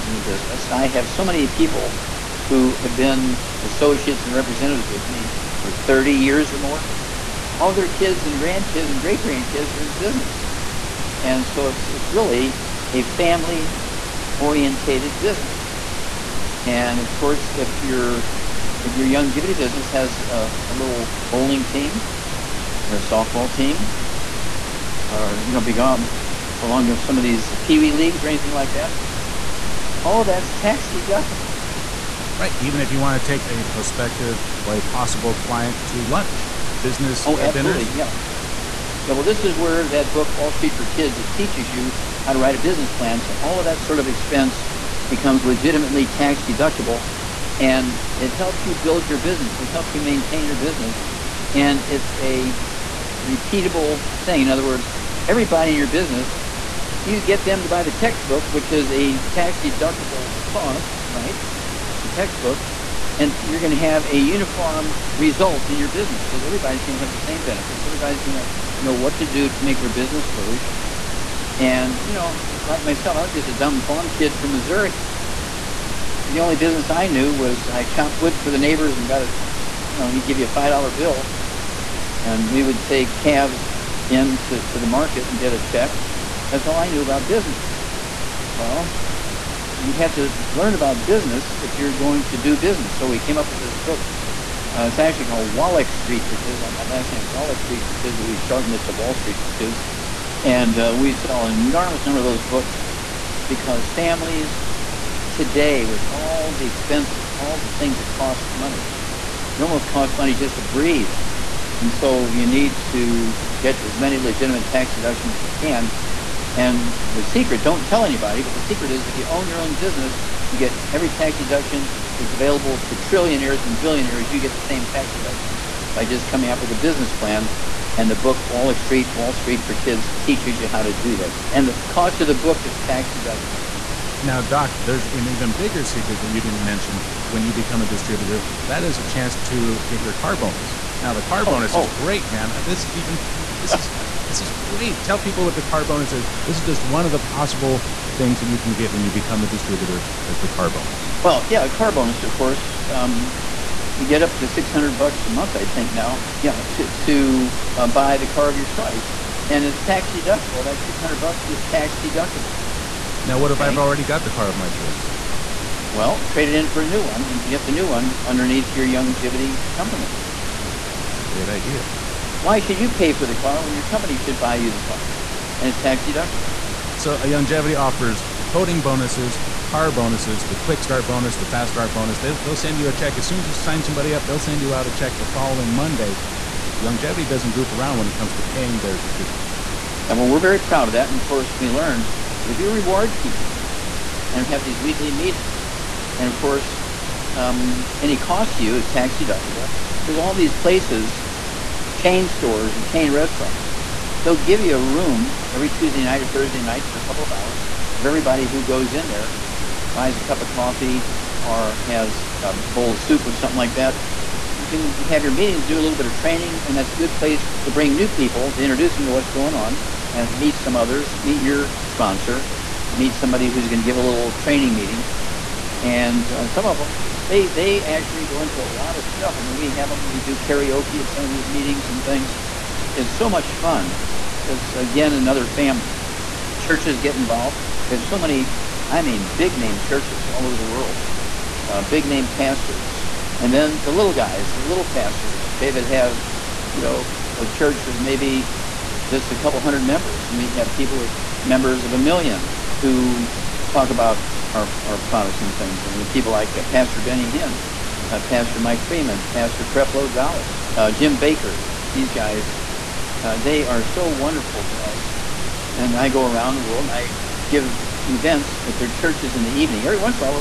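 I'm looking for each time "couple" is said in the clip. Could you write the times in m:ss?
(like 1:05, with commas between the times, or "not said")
3:27, 4:09.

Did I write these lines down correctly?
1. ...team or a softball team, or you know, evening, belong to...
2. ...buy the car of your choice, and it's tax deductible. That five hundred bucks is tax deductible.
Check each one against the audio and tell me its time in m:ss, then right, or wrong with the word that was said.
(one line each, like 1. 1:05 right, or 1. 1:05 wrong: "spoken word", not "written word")
1. 0:21 wrong: "belong", not "evening"
2. 2:37 wrong: "six", not "five".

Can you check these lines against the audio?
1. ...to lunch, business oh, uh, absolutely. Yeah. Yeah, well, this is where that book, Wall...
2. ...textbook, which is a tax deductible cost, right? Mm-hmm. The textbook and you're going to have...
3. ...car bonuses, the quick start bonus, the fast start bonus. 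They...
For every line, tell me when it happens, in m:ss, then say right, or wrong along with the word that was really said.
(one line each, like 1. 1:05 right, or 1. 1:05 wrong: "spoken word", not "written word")
1. 0:35 right
2. 0:57 right
3. 2:59 right.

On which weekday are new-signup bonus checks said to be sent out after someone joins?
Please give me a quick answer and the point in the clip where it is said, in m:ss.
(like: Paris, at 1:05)
Monday, at 3:05.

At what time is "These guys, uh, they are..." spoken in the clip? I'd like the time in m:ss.
4:21.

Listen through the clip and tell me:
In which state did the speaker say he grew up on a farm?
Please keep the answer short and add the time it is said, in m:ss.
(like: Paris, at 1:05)
Missouri, at 1:14.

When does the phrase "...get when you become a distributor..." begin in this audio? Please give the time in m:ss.
2:28.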